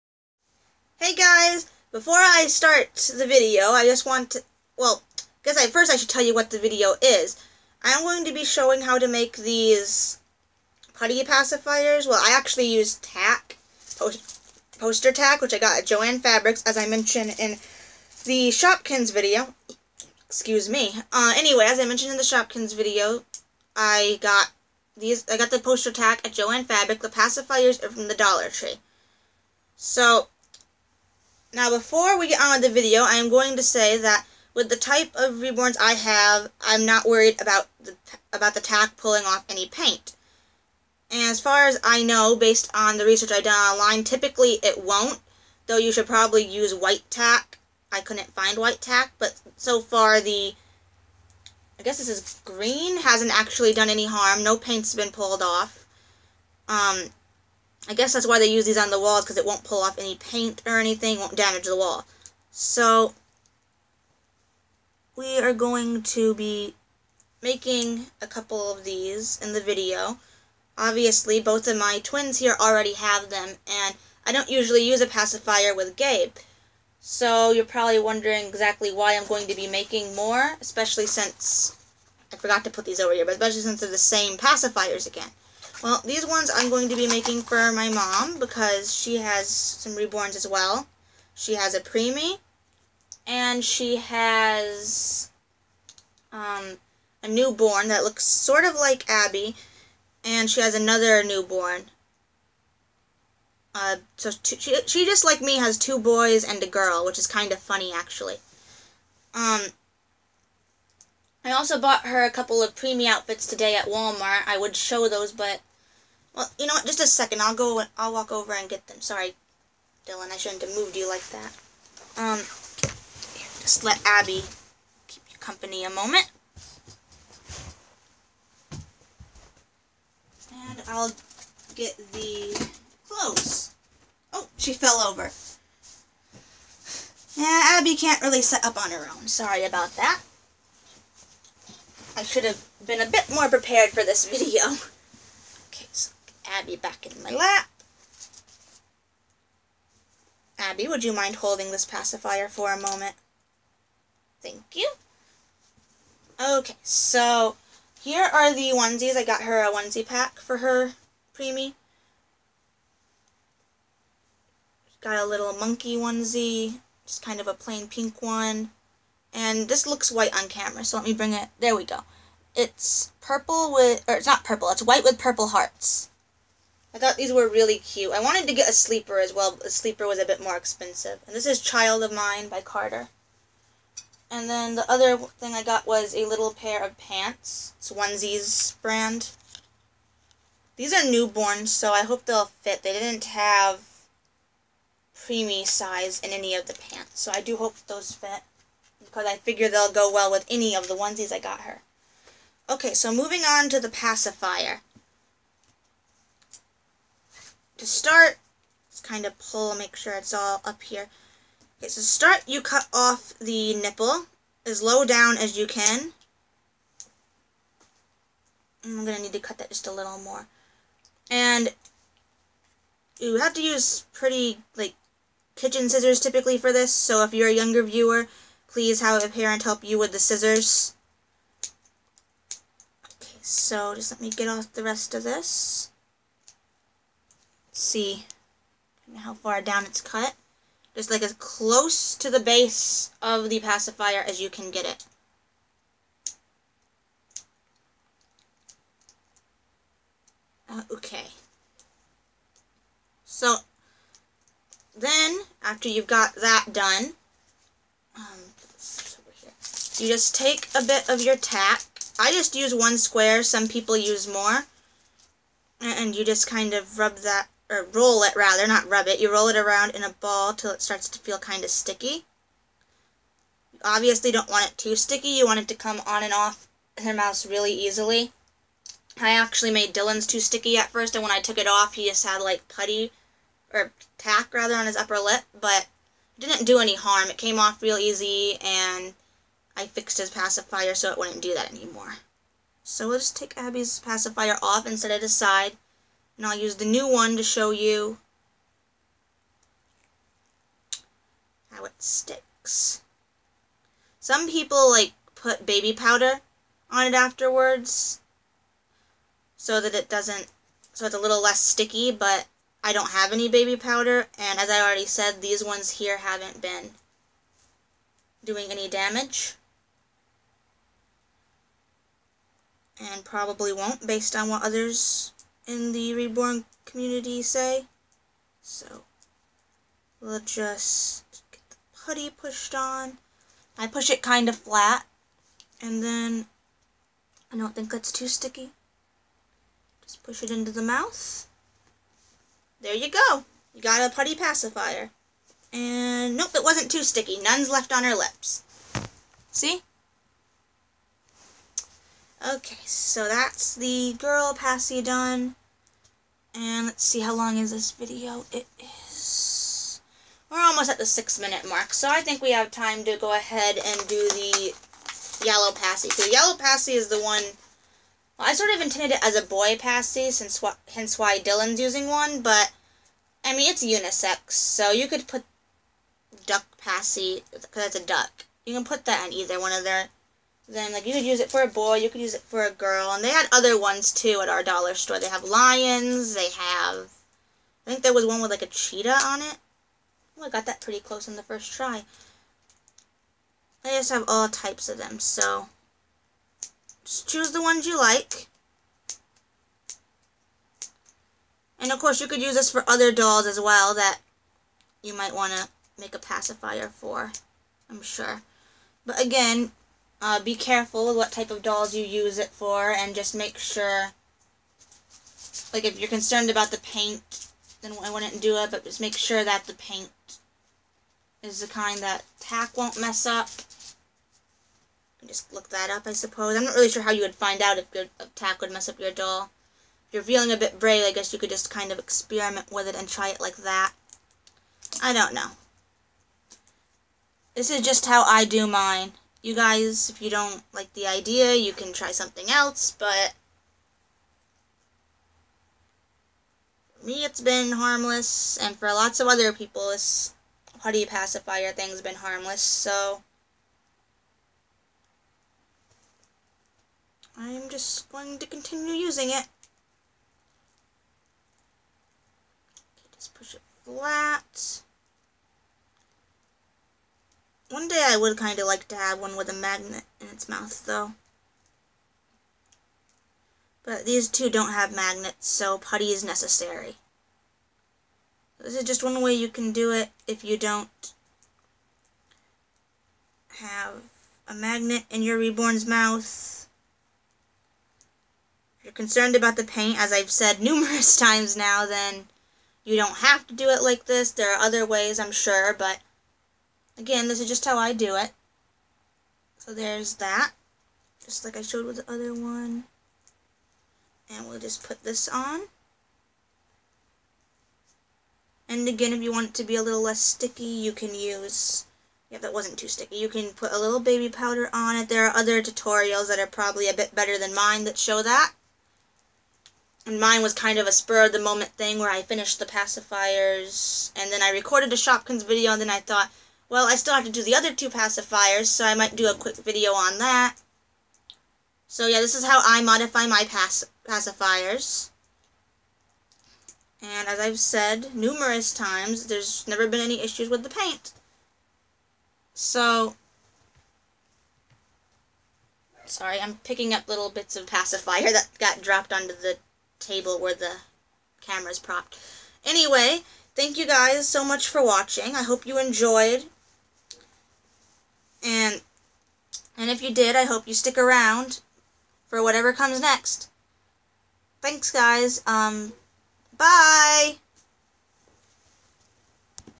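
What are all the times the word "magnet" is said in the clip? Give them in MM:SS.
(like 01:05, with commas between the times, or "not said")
07:49, 07:54, 08:04.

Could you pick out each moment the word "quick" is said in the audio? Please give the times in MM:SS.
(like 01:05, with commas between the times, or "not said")
08:49.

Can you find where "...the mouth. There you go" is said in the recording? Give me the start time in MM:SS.
05:40.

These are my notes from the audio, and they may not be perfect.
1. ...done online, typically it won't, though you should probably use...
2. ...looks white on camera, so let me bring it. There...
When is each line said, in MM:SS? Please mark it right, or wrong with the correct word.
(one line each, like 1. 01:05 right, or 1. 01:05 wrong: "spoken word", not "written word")
1. 00:43 right
2. 02:49 right.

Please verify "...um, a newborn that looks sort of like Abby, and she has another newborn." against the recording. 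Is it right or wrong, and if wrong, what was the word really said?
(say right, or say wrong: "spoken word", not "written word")
right.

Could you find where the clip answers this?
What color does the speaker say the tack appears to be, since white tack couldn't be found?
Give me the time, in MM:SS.
00:52.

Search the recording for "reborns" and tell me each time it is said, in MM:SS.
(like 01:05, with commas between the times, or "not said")
00:35, 01:29, 05:26, 08:05.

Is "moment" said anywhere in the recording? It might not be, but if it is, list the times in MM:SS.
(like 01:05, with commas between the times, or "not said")
02:05, 02:32, 08:40.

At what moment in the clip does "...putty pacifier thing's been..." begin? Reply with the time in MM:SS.
07:30.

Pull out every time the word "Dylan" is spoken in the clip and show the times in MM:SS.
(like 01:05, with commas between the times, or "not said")
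02:00, 04:39, 06:11.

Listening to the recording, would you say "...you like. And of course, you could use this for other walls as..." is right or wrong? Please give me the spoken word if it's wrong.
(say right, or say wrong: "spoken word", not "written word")
wrong: "dolls", not "walls".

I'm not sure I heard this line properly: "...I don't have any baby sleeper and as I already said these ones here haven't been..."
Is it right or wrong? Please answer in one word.
wrong.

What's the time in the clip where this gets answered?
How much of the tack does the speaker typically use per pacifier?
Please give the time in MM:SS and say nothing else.
04:22.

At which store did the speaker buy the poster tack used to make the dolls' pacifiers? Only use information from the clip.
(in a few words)
Joann Fabrics.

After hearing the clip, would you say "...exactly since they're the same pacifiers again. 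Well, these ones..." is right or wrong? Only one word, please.
wrong.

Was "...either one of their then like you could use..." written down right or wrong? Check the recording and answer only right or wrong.
right.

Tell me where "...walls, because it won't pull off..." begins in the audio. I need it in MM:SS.
00:58.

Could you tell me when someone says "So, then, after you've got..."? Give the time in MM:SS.
04:13.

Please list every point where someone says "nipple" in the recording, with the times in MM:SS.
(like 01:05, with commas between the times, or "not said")
03:33.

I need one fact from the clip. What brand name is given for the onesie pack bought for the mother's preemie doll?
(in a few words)
Child of Mine.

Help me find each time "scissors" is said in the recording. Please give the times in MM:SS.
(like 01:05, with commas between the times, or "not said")
03:45, 03:50.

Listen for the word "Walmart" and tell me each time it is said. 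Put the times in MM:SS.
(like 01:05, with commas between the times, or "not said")
01:53.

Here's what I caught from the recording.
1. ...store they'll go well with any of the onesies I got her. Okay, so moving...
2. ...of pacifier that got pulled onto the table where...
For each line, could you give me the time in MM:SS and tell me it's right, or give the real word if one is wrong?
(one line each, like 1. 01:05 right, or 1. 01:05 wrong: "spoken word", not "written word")
1. 03:19 wrong: "figure", not "store"
2. 09:07 wrong: "dropped", not "pulled".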